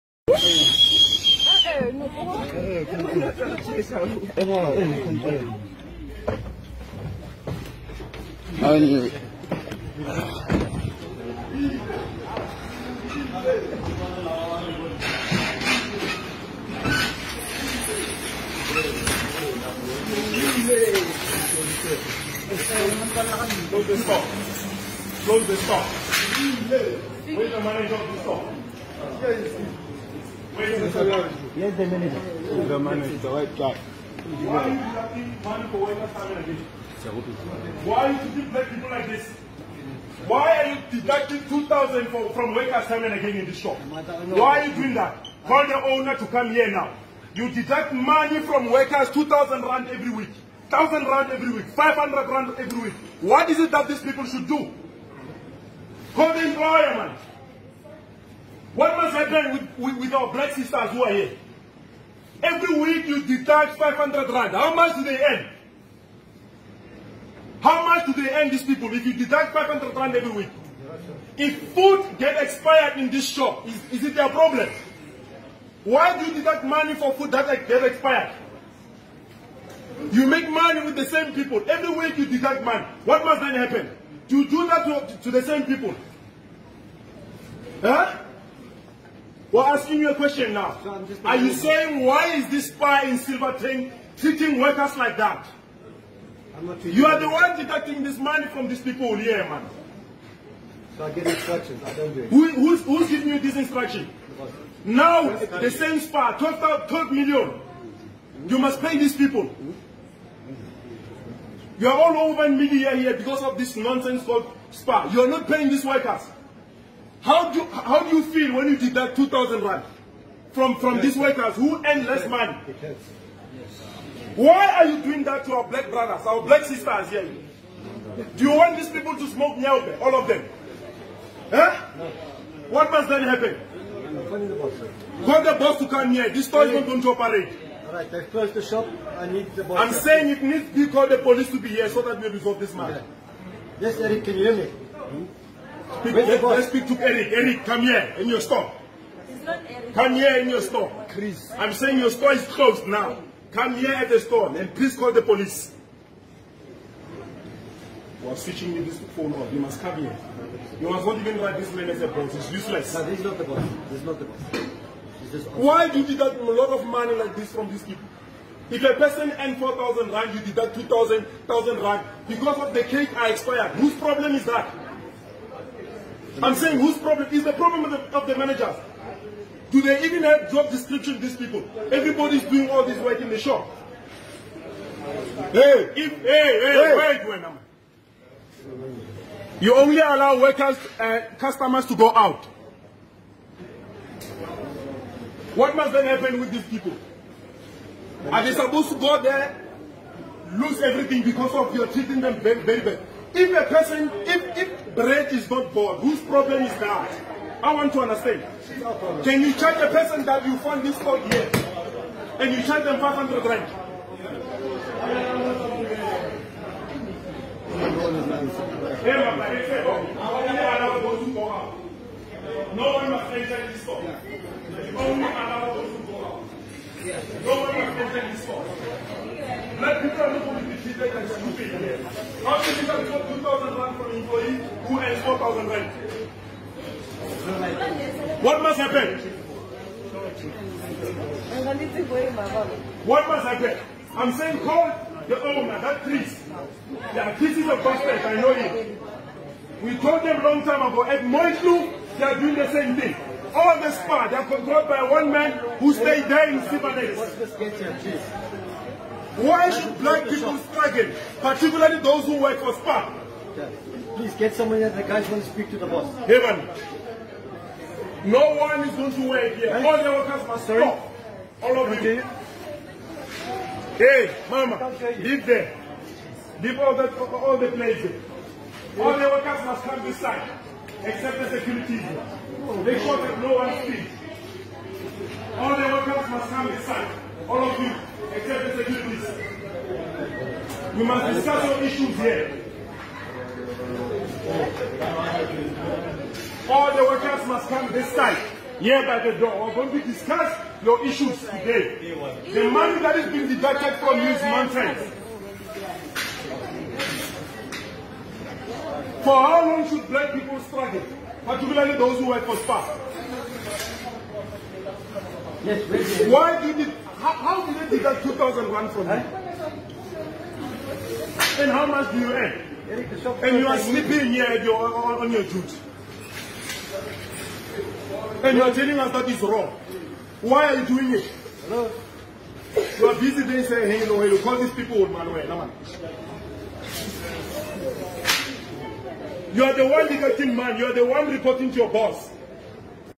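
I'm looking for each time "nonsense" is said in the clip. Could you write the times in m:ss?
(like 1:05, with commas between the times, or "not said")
1:53, 5:04.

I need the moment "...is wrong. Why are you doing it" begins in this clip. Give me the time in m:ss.
5:29.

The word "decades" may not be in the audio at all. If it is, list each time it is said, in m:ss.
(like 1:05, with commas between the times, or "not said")
not said.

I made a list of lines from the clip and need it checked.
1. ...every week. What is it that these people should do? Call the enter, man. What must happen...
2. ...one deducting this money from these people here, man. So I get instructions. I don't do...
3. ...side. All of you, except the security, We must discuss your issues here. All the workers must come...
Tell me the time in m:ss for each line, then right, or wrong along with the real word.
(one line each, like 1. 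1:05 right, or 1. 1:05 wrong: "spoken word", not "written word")
1. 0:52 wrong: "employer", not "enter"
2. 1:37 right
3. 4:46 right.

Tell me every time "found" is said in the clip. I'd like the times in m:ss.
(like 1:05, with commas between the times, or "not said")
3:30.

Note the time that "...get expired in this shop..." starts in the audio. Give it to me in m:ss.
1:12.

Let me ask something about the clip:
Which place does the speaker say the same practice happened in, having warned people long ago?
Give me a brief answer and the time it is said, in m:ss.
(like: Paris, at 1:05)
Moitlu, at 4:11.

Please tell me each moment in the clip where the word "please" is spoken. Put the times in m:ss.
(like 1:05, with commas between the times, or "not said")
2:34, 4:24.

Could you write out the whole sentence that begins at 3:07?
wait, wait, You only allow workers, uh, customers to go out.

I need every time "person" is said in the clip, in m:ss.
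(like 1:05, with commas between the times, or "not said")
2:48, 3:23, 3:29.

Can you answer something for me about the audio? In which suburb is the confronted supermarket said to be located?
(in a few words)
Silverton.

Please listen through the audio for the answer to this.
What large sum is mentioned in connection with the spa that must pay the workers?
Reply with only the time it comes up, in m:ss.
1:46.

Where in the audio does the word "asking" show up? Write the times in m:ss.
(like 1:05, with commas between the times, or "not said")
1:29.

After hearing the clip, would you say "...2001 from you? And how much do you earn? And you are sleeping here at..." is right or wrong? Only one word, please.
right.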